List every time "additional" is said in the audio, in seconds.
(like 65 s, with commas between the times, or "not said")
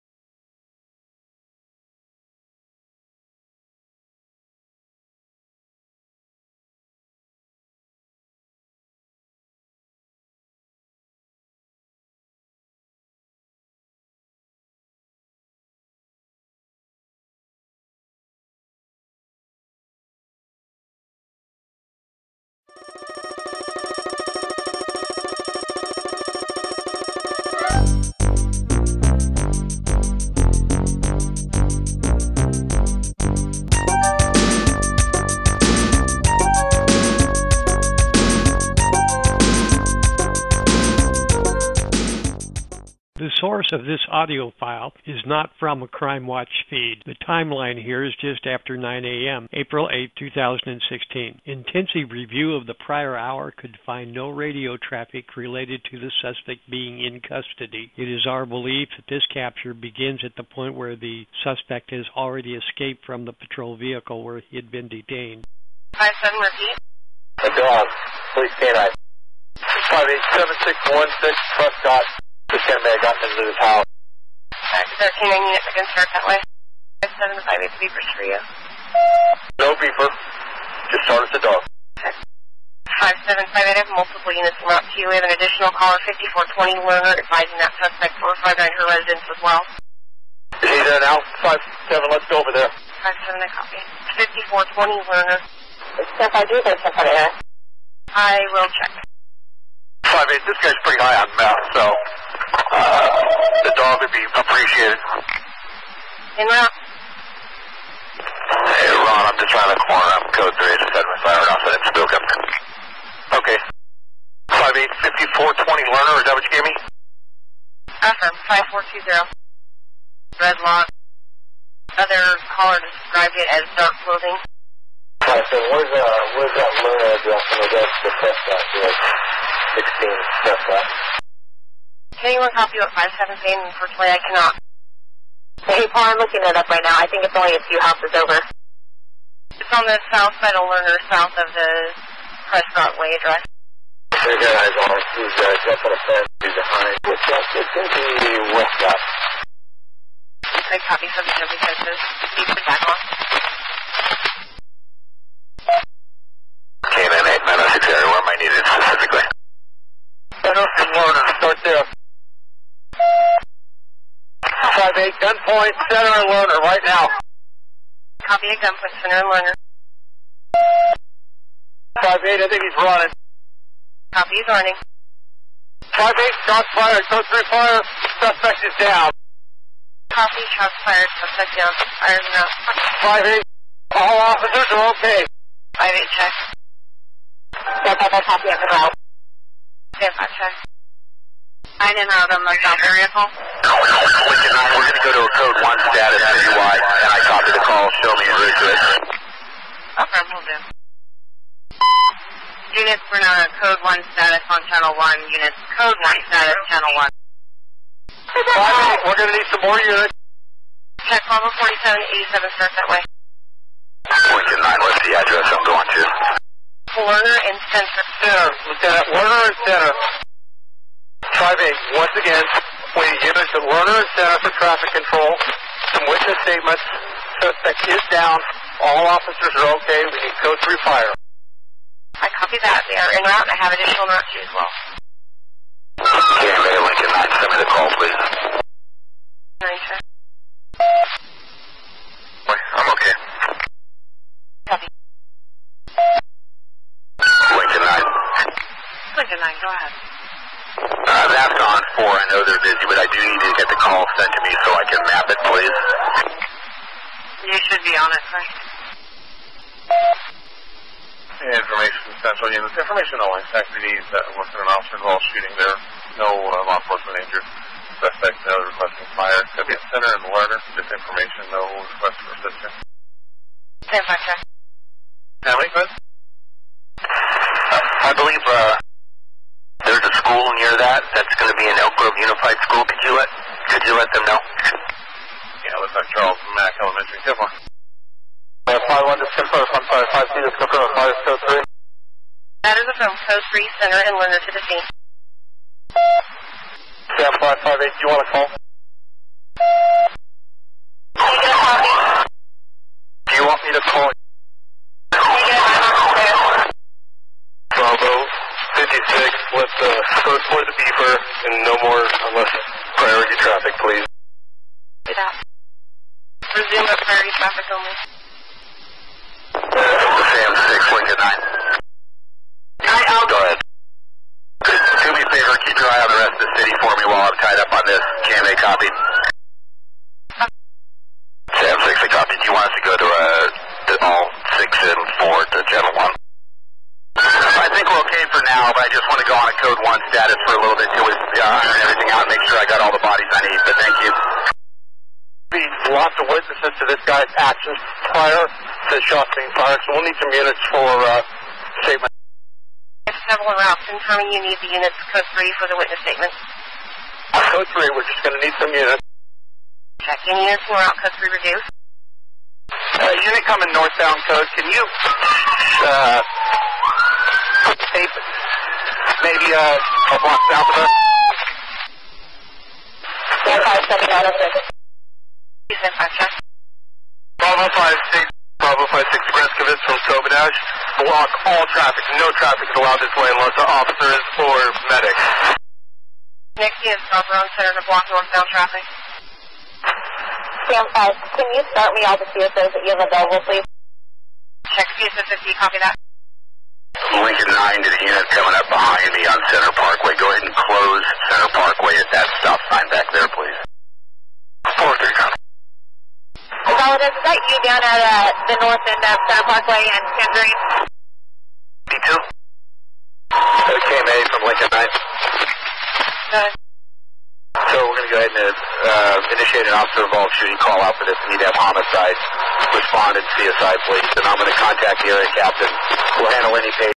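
85 s, 233 s.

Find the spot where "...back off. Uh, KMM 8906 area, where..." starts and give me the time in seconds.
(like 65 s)
152 s.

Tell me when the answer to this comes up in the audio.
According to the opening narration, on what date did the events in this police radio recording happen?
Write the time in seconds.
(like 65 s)
49 s.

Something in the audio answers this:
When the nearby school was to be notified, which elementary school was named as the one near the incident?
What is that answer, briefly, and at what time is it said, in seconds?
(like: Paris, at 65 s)
Dr. Charles Mack Elementary, at 285 s.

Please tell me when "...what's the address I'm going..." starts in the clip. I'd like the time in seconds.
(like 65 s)
214 s.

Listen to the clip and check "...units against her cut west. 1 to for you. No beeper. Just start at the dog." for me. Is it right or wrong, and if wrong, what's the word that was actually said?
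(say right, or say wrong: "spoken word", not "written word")
wrong: "7", not "1".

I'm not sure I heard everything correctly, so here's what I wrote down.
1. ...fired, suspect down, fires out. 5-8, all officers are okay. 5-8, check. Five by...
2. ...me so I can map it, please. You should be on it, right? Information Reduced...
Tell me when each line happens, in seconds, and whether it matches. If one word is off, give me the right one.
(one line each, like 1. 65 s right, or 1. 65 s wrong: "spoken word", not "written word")
1. 180 s right
2. 254 s wrong: "Central", not "Reduced".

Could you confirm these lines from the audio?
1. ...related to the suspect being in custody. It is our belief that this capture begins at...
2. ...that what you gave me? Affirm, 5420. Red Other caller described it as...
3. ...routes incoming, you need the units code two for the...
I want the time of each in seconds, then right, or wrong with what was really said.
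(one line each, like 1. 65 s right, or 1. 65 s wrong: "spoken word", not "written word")
1. 55 s right
2. 116 s right
3. 353 s wrong: "three", not "two".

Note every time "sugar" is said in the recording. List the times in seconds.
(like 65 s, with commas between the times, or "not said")
not said.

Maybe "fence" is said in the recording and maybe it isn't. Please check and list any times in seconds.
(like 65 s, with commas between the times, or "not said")
146 s, 151 s.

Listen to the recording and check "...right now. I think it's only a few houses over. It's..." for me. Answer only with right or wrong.
right.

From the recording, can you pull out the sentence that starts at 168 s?
Copy at gunpoint, center and loader.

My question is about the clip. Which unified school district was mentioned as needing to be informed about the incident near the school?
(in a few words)
Elk Grove Unified.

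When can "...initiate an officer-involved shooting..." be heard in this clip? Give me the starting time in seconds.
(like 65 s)
419 s.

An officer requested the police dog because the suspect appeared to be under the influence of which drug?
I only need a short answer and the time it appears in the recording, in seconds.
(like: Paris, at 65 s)
meth, at 101 s.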